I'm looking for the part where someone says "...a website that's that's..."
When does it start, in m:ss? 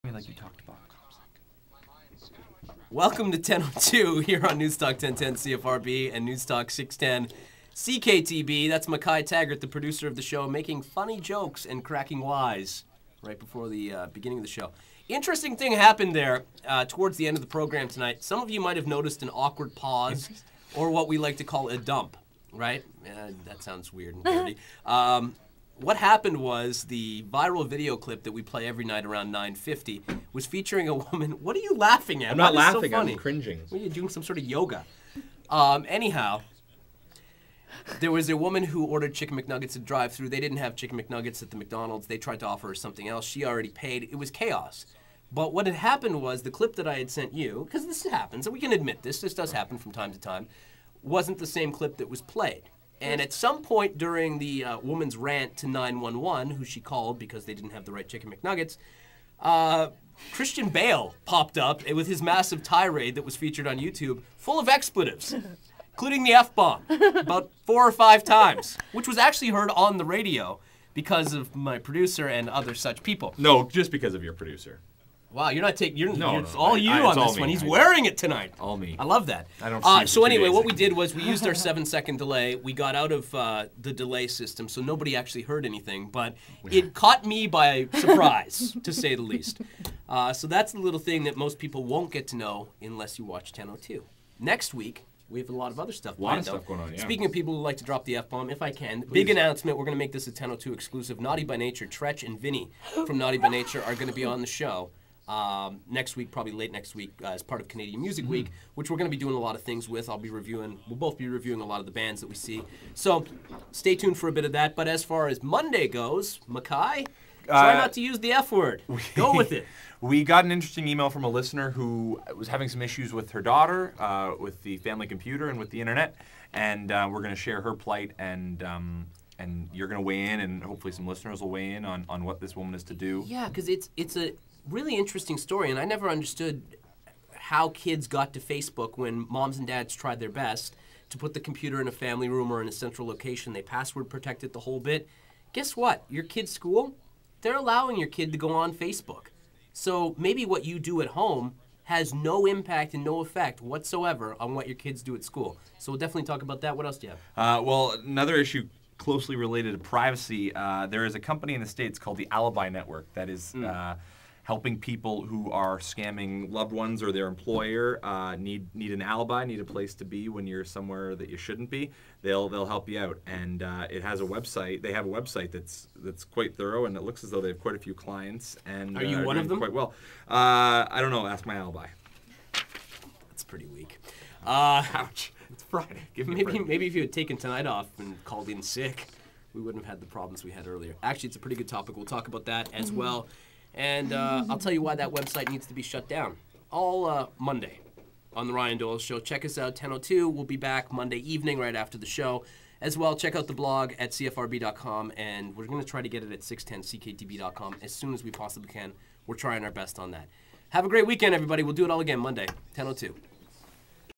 2:55.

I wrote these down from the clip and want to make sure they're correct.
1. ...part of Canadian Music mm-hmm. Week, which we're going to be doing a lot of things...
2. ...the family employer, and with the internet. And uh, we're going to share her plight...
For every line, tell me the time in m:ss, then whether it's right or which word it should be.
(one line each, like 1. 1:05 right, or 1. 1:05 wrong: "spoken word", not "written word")
1. 1:47 right
2. 2:04 wrong: "computer", not "employer".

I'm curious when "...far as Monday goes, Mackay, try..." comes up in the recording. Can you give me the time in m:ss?
1:55.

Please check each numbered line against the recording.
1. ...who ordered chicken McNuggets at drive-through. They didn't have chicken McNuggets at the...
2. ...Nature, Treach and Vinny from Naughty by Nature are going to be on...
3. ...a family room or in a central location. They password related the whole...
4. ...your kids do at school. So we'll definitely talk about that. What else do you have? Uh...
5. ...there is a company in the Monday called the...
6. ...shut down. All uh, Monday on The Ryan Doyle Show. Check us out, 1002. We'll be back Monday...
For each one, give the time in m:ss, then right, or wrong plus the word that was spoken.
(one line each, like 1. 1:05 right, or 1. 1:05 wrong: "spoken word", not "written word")
1. 0:38 right
2. 1:41 right
3. 2:21 wrong: "protected", not "related"
4. 2:34 right
5. 2:40 wrong: "States", not "Monday"
6. 3:15 right.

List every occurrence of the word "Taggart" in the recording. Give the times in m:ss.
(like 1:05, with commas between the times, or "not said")
0:09.